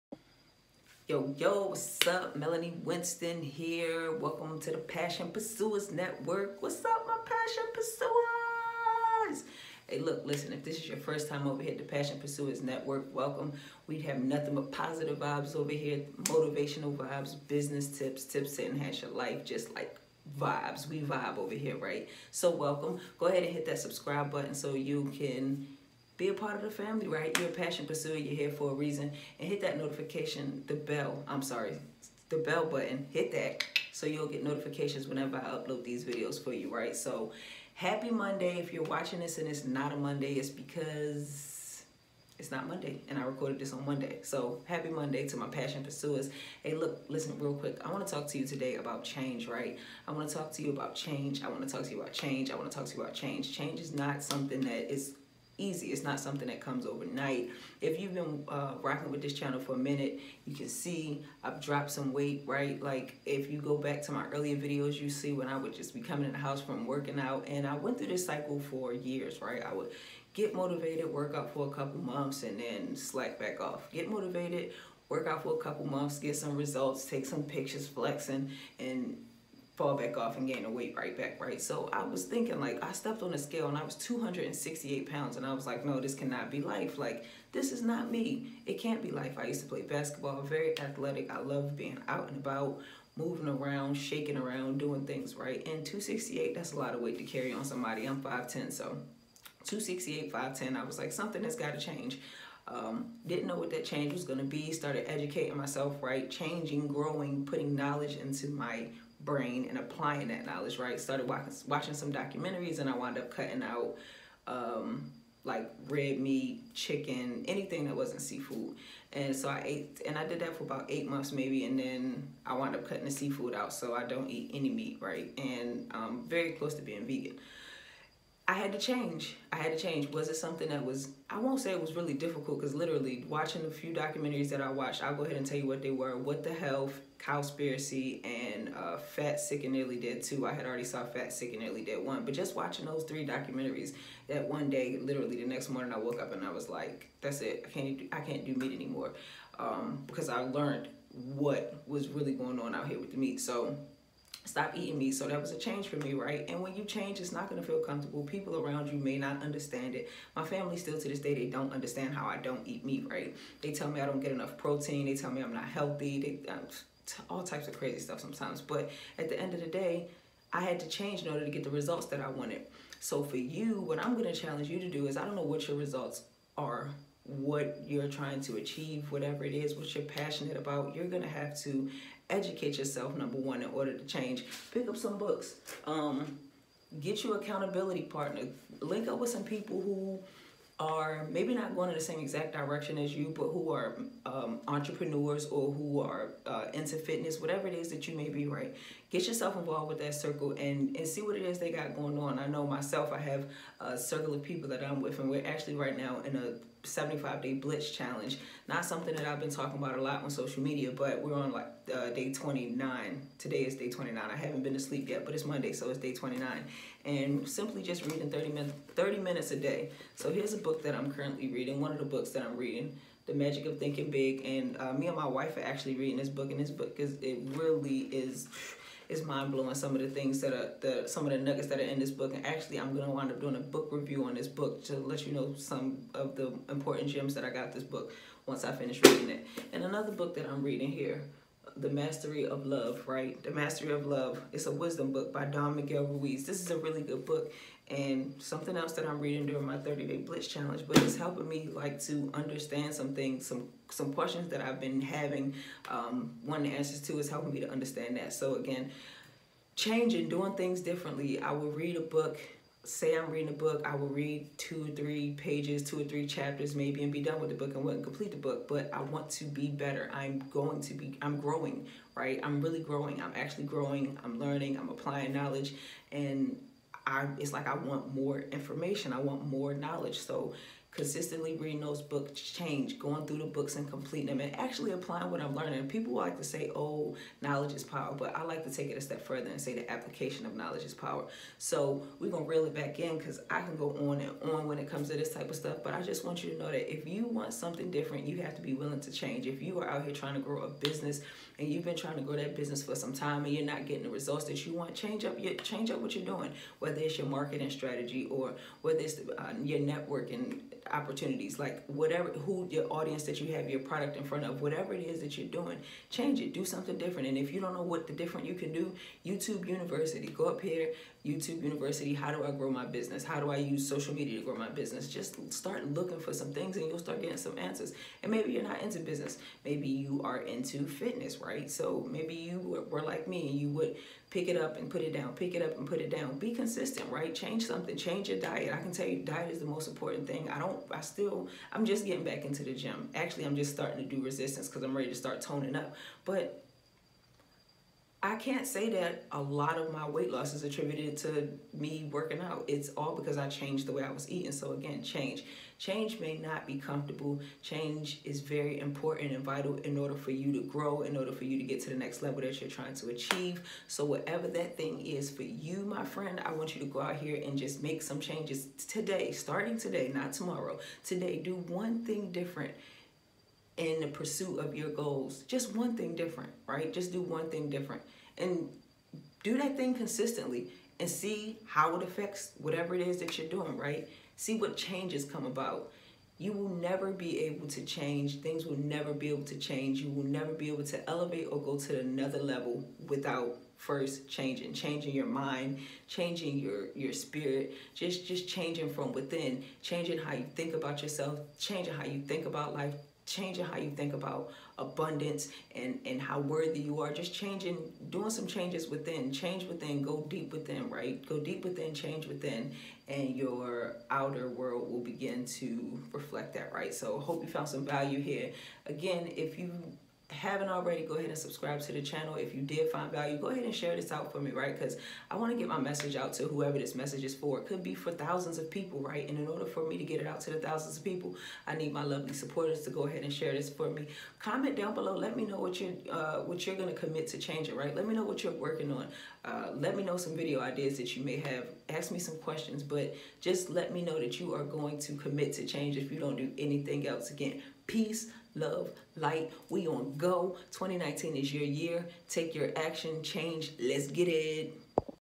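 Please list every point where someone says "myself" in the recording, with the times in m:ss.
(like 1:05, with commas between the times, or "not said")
1:45, 3:22.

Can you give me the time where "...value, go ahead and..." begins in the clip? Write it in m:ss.
7:03.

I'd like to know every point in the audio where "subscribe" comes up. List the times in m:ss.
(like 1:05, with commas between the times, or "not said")
0:23, 7:01.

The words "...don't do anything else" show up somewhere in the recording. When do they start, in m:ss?
7:26.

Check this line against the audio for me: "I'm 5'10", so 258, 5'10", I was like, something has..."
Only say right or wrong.
wrong.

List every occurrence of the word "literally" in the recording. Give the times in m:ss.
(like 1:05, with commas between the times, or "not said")
2:12, 2:24.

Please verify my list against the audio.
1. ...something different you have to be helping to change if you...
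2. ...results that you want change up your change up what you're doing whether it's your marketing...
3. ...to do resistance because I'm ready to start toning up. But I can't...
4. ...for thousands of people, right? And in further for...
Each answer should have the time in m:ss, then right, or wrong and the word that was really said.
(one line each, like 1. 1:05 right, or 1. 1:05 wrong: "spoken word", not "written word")
1. 4:57 wrong: "willing", not "helping"
2. 5:04 right
3. 5:44 right
4. 7:07 wrong: "order", not "further".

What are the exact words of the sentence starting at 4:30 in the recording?
I'm going to be, I'm growing, right?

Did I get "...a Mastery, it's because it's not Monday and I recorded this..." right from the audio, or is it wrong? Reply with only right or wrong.
wrong.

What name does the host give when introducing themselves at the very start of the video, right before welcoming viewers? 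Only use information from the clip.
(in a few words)
Melanie Winston.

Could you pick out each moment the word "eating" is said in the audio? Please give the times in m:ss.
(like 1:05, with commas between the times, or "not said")
2:34, 5:54.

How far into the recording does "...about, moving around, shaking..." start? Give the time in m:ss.
1:32.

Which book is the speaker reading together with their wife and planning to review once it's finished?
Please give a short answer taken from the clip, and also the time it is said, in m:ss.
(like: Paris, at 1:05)
The Magic of Thinking Big, at 3:43.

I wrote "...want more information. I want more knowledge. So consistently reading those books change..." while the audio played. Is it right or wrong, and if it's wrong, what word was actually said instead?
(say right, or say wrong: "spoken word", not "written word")
right.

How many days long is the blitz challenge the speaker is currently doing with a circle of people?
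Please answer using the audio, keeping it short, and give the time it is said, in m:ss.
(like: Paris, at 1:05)
75, at 3:26.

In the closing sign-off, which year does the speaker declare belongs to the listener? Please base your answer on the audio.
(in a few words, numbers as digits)
2019.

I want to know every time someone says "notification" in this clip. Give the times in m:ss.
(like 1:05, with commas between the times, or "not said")
0:29, 0:34.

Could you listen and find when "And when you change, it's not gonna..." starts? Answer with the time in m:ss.
2:36.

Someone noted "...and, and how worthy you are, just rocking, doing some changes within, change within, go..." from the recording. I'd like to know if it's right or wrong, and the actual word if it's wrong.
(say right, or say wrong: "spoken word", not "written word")
wrong: "changing", not "rocking".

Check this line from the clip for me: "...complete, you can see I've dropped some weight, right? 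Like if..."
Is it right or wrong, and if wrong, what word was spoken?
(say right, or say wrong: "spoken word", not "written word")
wrong: "minute", not "complete".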